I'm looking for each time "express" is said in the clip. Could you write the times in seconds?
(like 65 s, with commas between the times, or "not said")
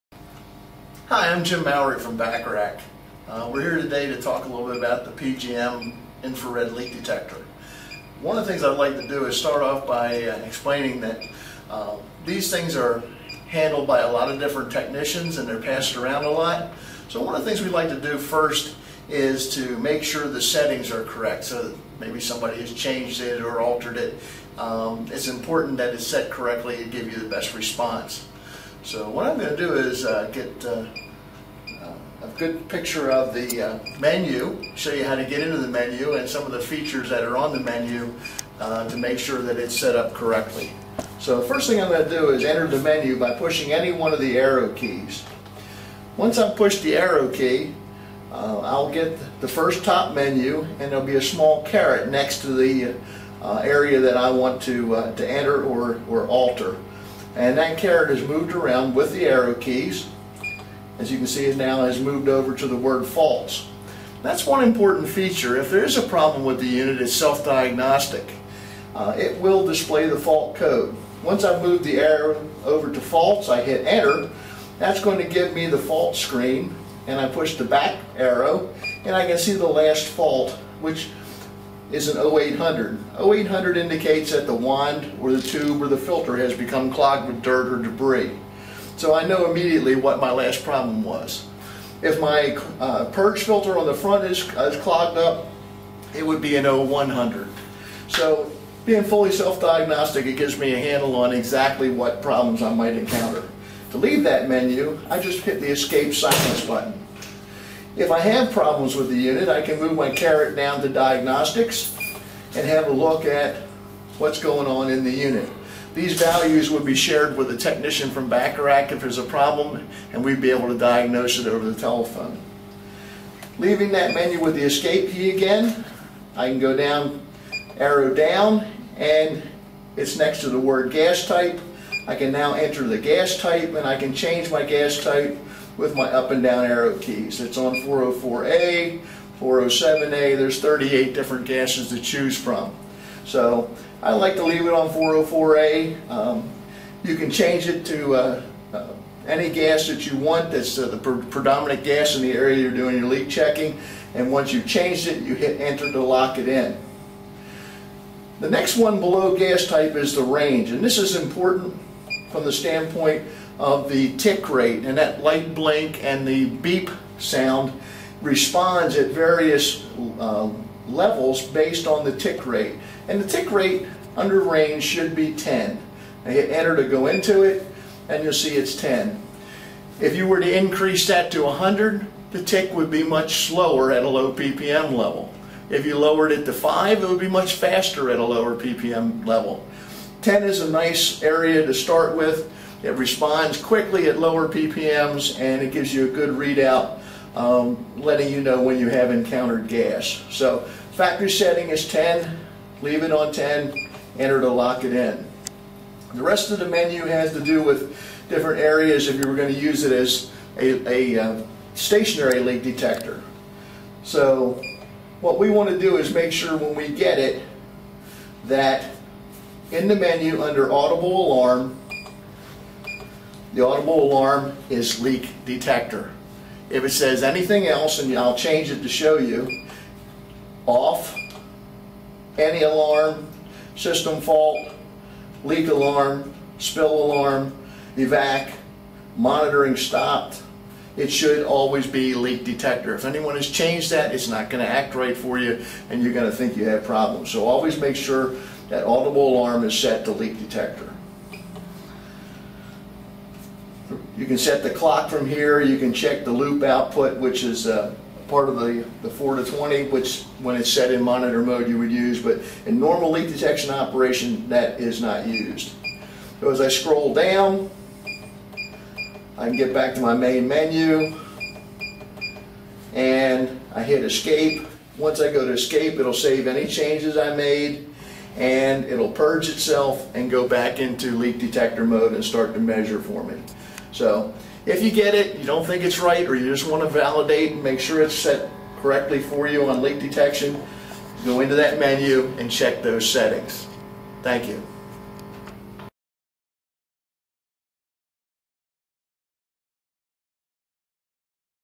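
not said.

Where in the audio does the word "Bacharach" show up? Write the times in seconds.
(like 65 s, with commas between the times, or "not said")
2 s, 118 s.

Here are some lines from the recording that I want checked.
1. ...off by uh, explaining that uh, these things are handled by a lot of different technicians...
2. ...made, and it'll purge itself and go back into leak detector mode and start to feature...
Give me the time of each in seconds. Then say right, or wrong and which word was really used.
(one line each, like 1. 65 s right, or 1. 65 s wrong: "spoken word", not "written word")
1. 9 s right
2. 277 s wrong: "measure", not "feature".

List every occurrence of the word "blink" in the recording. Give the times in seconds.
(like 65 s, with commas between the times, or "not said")
165 s.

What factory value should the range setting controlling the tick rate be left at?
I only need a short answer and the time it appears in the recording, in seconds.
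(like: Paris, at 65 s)
10, at 200 s.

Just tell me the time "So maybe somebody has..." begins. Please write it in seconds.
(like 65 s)
21 s.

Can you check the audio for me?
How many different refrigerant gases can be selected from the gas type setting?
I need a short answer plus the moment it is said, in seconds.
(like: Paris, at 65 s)
38, at 140 s.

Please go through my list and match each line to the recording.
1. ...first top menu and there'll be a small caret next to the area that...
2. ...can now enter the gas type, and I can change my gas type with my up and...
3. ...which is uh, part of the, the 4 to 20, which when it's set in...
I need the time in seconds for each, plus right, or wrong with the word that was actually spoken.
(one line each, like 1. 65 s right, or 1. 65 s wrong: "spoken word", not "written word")
1. 49 s right
2. 132 s right
3. 257 s right.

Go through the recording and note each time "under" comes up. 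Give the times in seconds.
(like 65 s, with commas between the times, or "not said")
174 s, 220 s.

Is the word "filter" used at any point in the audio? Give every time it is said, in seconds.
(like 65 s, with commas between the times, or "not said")
85 s, 93 s.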